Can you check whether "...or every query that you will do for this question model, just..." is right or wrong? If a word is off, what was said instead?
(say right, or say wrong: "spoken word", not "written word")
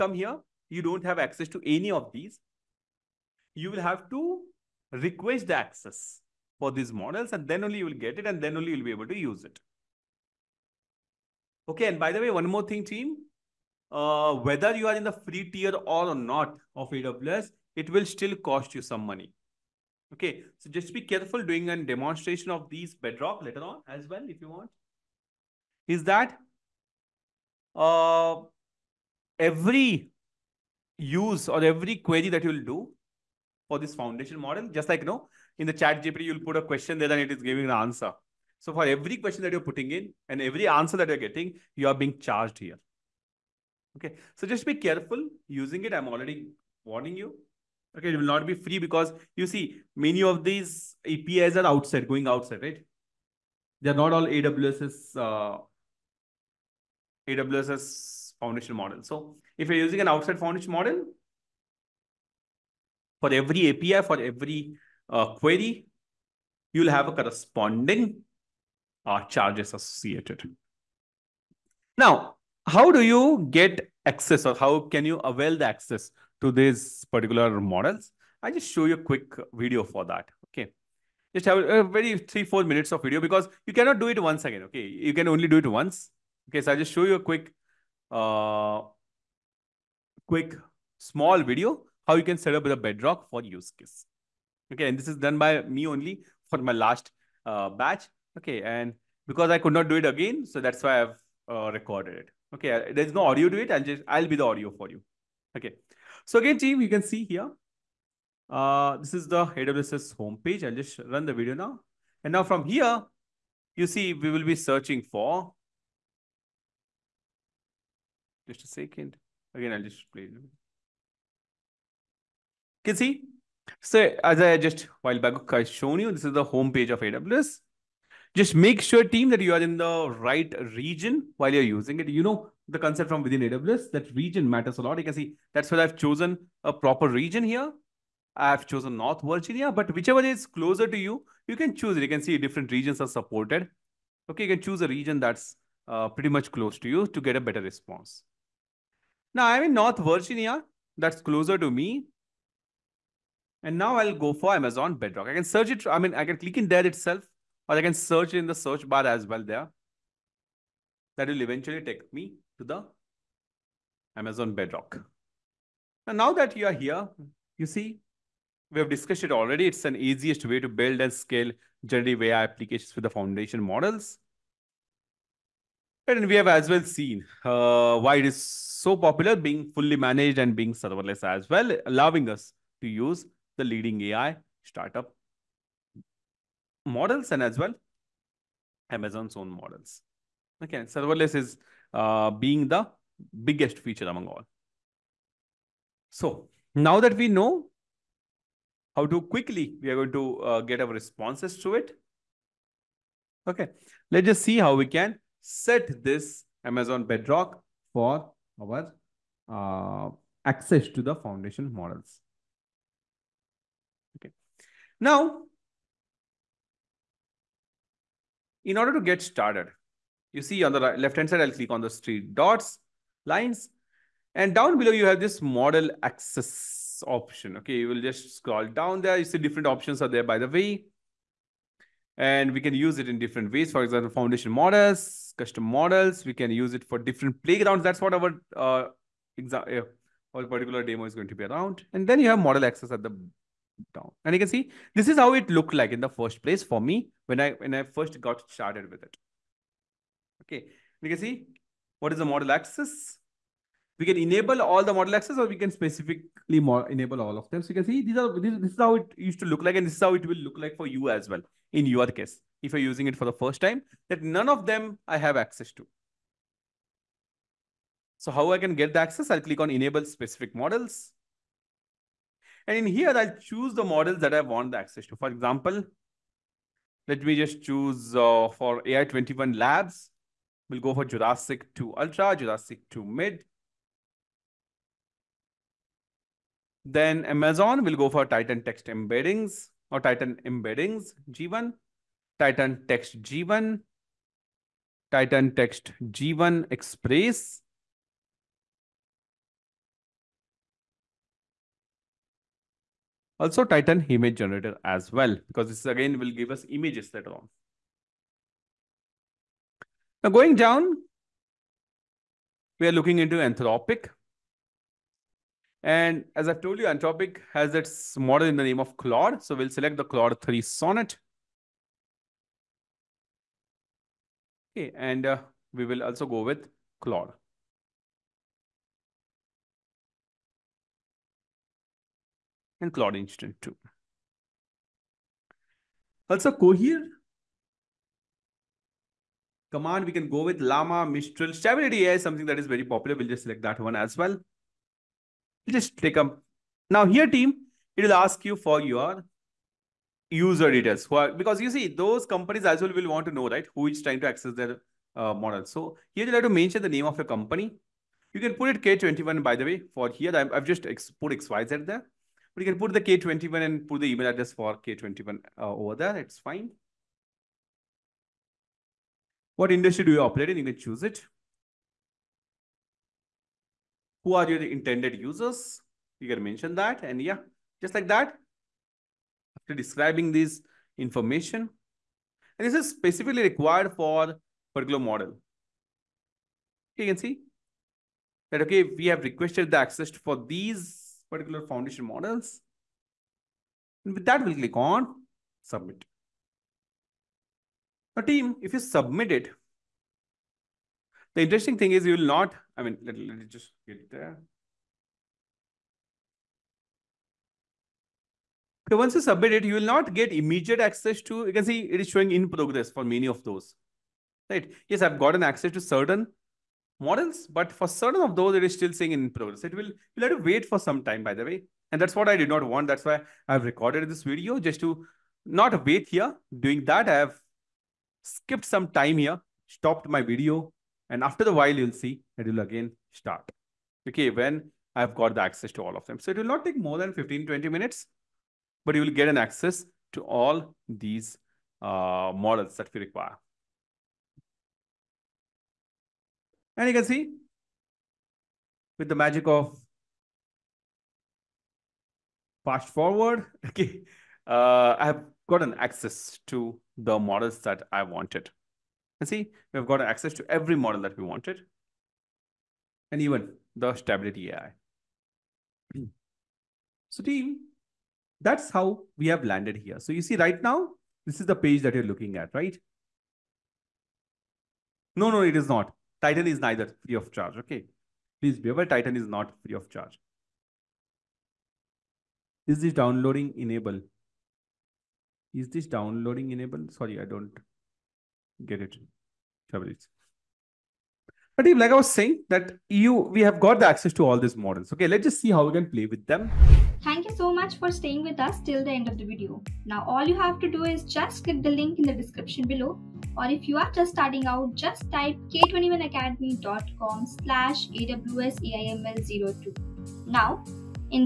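wrong: "foundation", not "question".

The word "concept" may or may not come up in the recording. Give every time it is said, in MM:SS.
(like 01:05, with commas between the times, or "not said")
02:12.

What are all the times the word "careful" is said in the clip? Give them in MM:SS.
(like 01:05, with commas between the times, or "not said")
00:21, 00:44.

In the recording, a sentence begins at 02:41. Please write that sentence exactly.
That will eventually take me to the Amazon Bedrock.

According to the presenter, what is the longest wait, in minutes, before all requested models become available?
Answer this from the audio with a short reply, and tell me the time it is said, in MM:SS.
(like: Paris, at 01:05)
20, at 07:17.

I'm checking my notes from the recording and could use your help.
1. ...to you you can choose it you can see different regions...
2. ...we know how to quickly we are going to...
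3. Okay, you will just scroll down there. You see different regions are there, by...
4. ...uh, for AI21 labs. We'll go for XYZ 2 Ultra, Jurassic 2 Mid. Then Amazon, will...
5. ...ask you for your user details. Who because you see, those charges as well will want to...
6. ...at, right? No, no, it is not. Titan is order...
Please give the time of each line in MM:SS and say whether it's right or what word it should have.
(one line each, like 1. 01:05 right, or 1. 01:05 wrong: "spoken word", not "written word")
1. 02:20 right
2. 03:17 right
3. 03:47 wrong: "options", not "regions"
4. 04:38 wrong: "Jurassic", not "XYZ"
5. 05:48 wrong: "companies", not "charges"
6. 07:52 wrong: "neither", not "order".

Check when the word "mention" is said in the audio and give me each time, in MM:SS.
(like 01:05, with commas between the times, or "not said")
05:56, 06:16.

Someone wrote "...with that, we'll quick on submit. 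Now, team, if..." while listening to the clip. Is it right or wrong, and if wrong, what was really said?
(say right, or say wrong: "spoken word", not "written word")
wrong: "click", not "quick".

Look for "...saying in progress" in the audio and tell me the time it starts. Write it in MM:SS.
06:58.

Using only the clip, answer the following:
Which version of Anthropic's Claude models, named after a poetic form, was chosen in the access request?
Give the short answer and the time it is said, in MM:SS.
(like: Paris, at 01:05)
Claude 3 Sonnet, at 05:20.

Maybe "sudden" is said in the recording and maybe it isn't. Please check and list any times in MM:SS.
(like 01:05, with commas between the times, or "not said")
not said.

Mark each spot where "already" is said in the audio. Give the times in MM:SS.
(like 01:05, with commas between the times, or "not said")
00:46, 02:49.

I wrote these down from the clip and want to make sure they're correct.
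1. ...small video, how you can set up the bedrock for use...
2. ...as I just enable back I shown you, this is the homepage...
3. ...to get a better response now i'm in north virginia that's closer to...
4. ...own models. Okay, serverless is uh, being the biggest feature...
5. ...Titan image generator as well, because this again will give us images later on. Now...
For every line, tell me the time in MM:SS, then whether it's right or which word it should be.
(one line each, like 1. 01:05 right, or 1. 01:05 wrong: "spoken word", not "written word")
1. 01:30 right
2. 02:04 wrong: "while", not "enable"
3. 02:27 right
4. 03:09 right
5. 05:03 right.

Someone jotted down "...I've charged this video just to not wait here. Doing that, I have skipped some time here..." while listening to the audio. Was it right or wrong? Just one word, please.
wrong.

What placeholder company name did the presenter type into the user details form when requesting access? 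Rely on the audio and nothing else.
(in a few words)
XYZ.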